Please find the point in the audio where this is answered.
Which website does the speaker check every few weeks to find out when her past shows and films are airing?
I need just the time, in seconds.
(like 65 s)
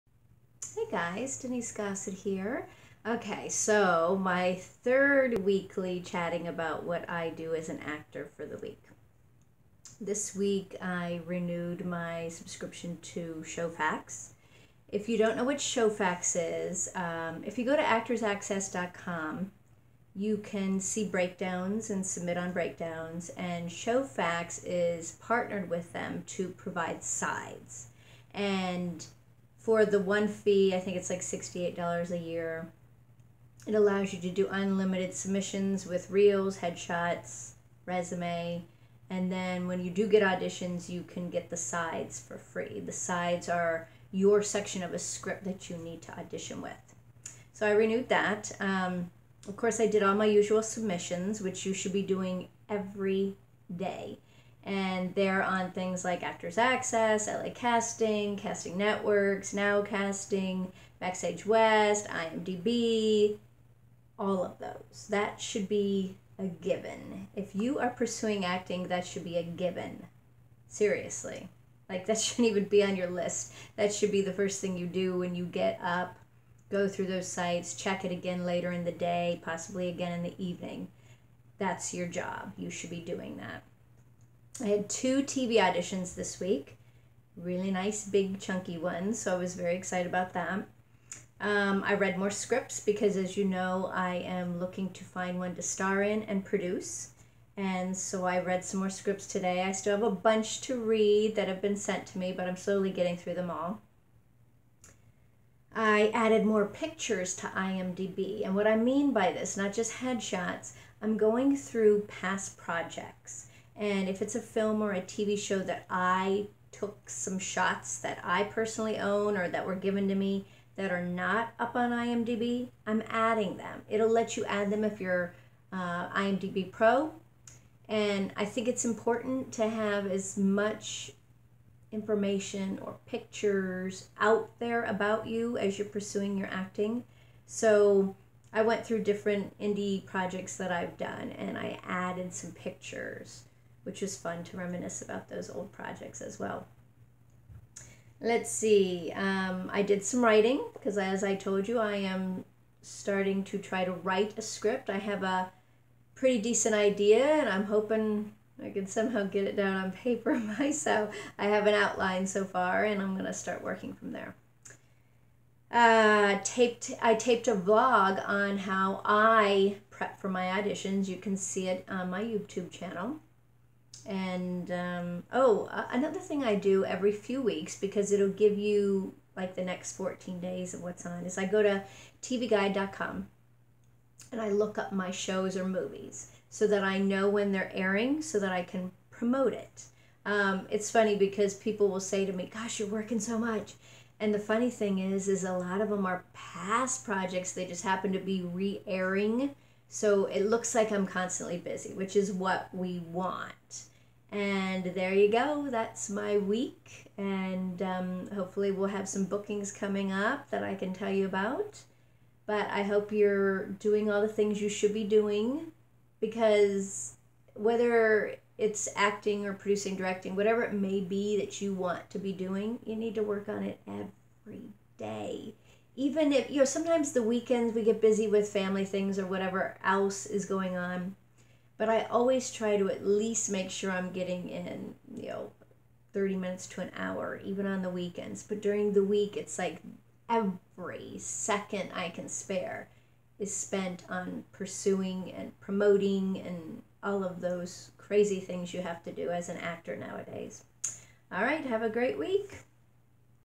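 182 s.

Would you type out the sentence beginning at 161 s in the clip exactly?
I have an outline so far and I'm going to start working from there.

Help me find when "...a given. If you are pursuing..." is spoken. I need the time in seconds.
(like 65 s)
66 s.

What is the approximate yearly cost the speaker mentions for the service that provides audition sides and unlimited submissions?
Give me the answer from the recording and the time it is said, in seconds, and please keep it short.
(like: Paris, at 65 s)
$68, at 31 s.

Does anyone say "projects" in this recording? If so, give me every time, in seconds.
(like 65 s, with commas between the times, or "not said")
112 s, 140 s, 145 s, 197 s.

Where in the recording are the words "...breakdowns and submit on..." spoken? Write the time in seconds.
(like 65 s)
21 s.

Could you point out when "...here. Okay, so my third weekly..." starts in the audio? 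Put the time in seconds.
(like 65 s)
2 s.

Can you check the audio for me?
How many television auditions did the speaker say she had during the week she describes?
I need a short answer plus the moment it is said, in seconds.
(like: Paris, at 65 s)
2, at 84 s.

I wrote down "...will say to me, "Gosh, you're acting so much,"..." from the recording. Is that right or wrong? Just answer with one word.
wrong.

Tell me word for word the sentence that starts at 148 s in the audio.
Let's see, um, I did some writing because, as I told you, I am starting to try to write a script.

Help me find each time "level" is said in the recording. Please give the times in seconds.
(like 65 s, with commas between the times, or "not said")
not said.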